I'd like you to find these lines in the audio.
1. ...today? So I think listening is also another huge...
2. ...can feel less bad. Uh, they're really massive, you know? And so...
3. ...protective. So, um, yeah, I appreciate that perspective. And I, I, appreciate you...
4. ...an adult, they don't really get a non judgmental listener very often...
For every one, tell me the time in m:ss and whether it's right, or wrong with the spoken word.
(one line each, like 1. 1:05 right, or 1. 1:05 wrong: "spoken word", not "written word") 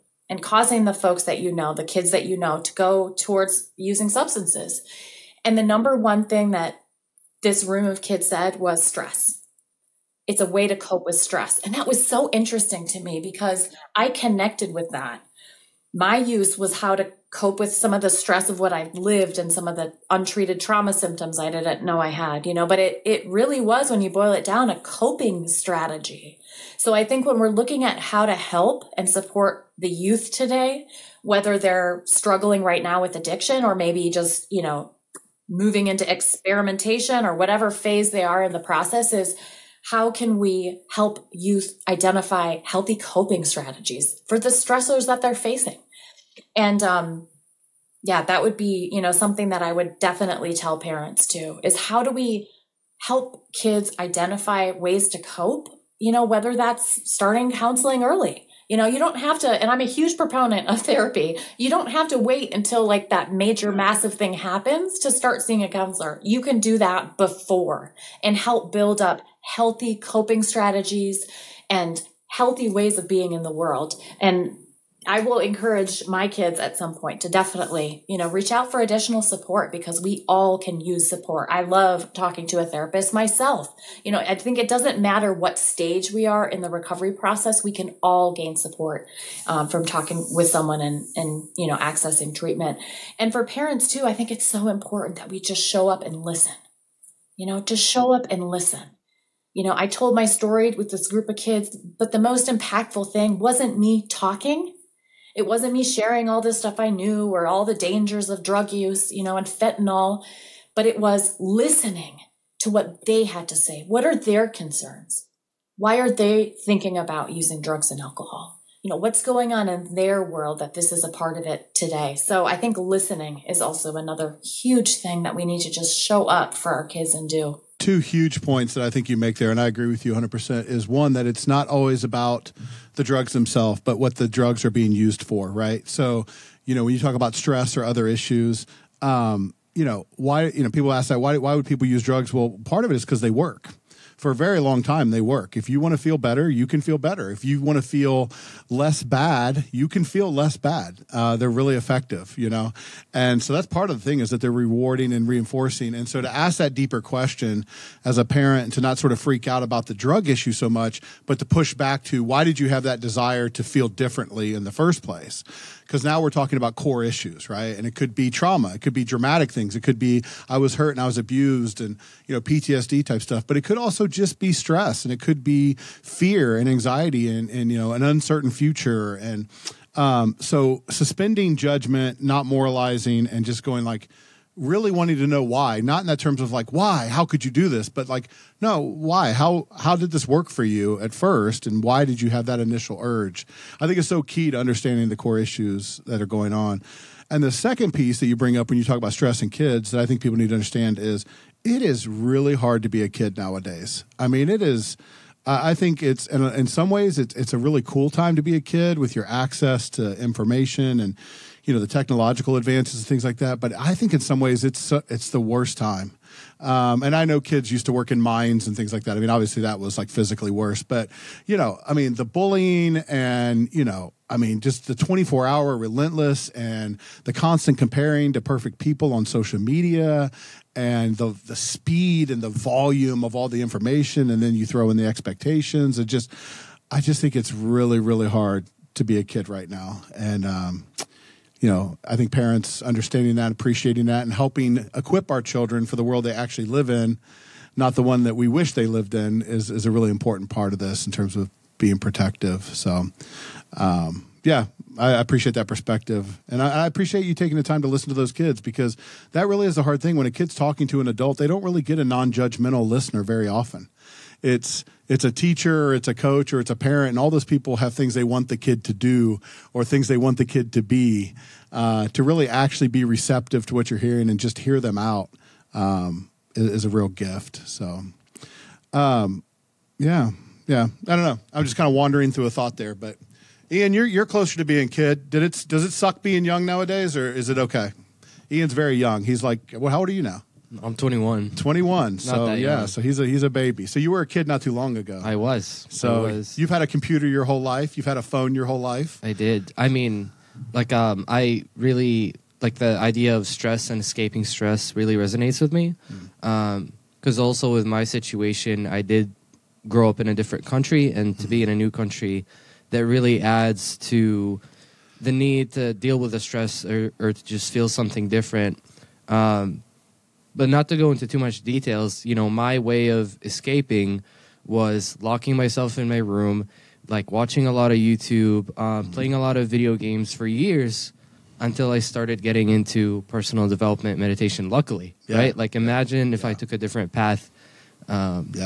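1. 2:01 right
2. 2:29 wrong: "effective", not "massive"
3. 4:11 right
4. 4:21 right.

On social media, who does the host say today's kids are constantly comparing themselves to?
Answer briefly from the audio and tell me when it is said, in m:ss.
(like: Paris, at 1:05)
perfect people, at 3:48.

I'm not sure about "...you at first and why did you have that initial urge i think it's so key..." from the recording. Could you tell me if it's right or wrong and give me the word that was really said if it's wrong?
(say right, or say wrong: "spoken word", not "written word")
right.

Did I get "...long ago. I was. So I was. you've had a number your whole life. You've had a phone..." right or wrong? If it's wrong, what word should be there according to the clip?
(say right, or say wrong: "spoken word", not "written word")
wrong: "computer", not "number".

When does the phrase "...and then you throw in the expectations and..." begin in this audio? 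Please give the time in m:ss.
3:54.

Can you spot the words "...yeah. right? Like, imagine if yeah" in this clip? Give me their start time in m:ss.
5:35.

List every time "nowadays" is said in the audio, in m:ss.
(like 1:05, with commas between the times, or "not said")
3:23, 4:46.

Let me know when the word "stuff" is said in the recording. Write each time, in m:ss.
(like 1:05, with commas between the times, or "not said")
1:46, 2:53.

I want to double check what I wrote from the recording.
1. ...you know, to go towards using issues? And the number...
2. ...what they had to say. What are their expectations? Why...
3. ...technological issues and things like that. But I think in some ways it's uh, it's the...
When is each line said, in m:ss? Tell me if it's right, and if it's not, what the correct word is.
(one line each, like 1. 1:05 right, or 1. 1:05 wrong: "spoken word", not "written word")
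1. 0:02 wrong: "substances", not "issues"
2. 1:52 wrong: "concerns", not "expectations"
3. 3:31 wrong: "advances", not "issues".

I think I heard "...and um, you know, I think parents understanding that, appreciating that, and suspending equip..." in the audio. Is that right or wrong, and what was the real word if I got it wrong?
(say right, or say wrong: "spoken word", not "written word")
wrong: "helping", not "suspending".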